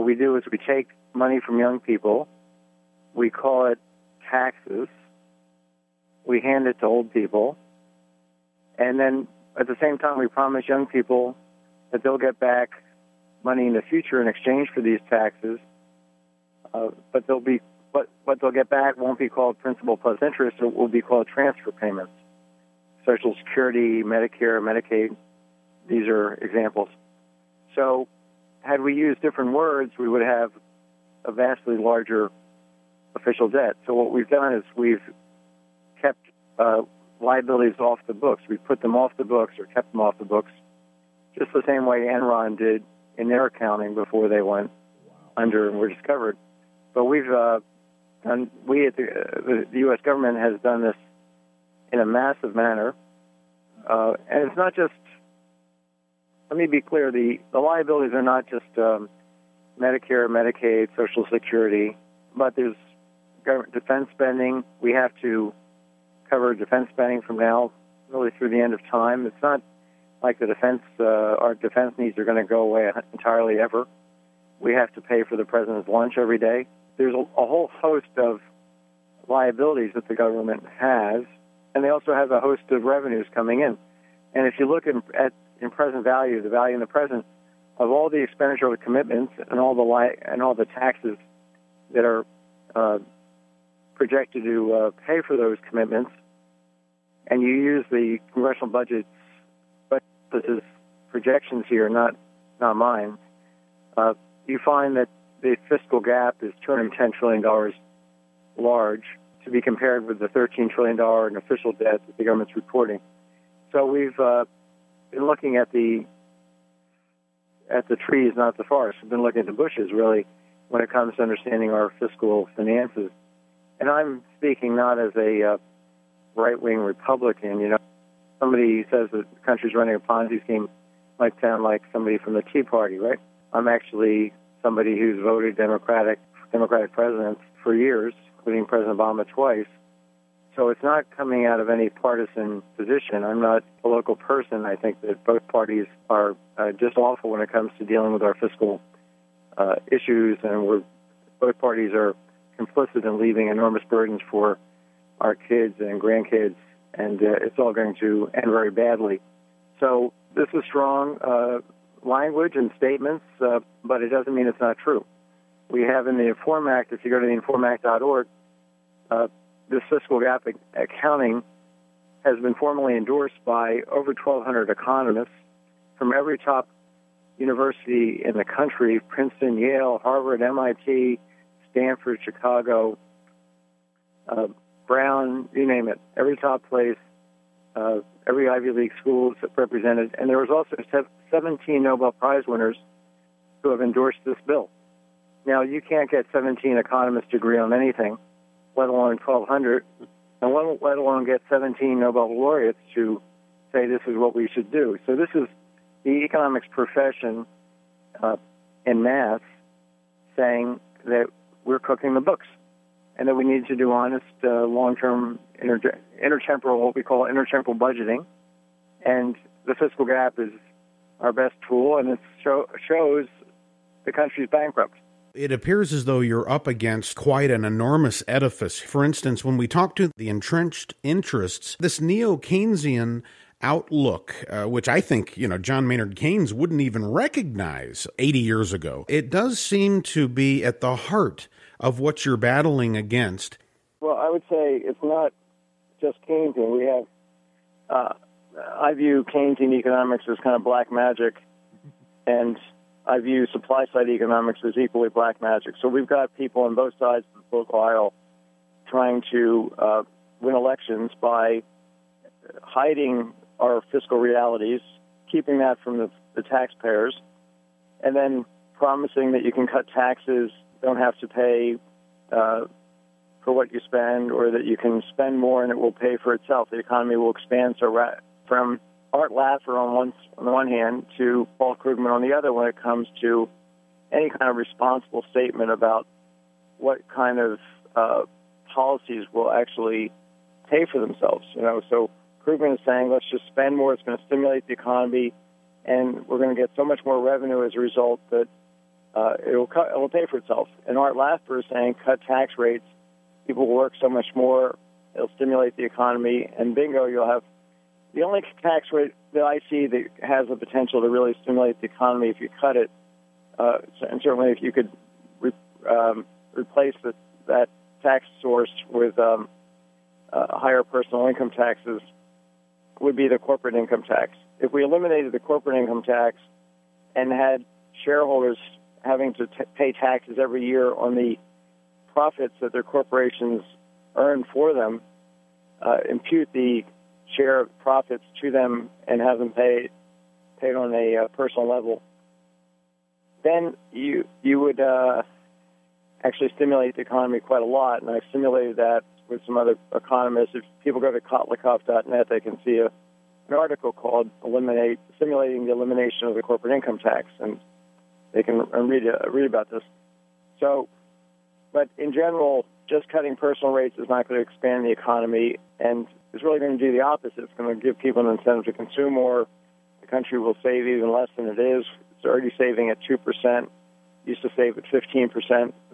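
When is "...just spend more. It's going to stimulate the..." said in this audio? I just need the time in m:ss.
4:53.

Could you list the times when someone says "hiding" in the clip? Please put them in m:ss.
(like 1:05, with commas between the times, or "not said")
4:22.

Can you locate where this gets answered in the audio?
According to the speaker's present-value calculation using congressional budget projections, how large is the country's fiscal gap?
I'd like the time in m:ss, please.
1:46.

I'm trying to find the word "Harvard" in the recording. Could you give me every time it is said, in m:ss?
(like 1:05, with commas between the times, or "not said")
3:00.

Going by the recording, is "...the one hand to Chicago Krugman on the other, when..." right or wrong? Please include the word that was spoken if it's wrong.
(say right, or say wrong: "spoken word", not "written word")
wrong: "Paul", not "Chicago".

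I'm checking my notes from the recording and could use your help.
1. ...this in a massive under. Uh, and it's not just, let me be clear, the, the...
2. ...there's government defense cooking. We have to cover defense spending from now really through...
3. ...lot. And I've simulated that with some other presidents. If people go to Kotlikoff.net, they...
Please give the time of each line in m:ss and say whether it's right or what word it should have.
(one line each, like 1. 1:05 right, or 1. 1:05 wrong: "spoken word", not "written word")
1. 0:50 wrong: "manner", not "under"
2. 1:02 wrong: "spending", not "cooking"
3. 5:47 wrong: "economists", not "presidents".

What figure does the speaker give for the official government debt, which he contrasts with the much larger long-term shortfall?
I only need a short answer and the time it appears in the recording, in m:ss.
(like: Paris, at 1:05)
$13 trillion, at 1:50.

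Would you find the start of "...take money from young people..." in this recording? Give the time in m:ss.
0:00.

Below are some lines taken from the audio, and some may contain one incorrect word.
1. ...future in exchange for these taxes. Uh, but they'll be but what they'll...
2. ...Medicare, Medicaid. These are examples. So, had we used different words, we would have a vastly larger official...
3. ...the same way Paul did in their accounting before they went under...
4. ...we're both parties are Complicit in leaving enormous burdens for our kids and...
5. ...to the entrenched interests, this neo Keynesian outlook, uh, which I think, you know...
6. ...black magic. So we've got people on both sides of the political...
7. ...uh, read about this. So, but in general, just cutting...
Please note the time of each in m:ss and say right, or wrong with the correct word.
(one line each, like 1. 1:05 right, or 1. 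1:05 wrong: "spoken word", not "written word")
1. 0:13 right
2. 0:24 right
3. 0:41 wrong: "Enron", not "Paul"
4. 2:30 right
5. 3:49 right
6. 4:15 right
7. 5:59 right.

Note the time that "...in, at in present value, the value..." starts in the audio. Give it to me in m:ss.
1:24.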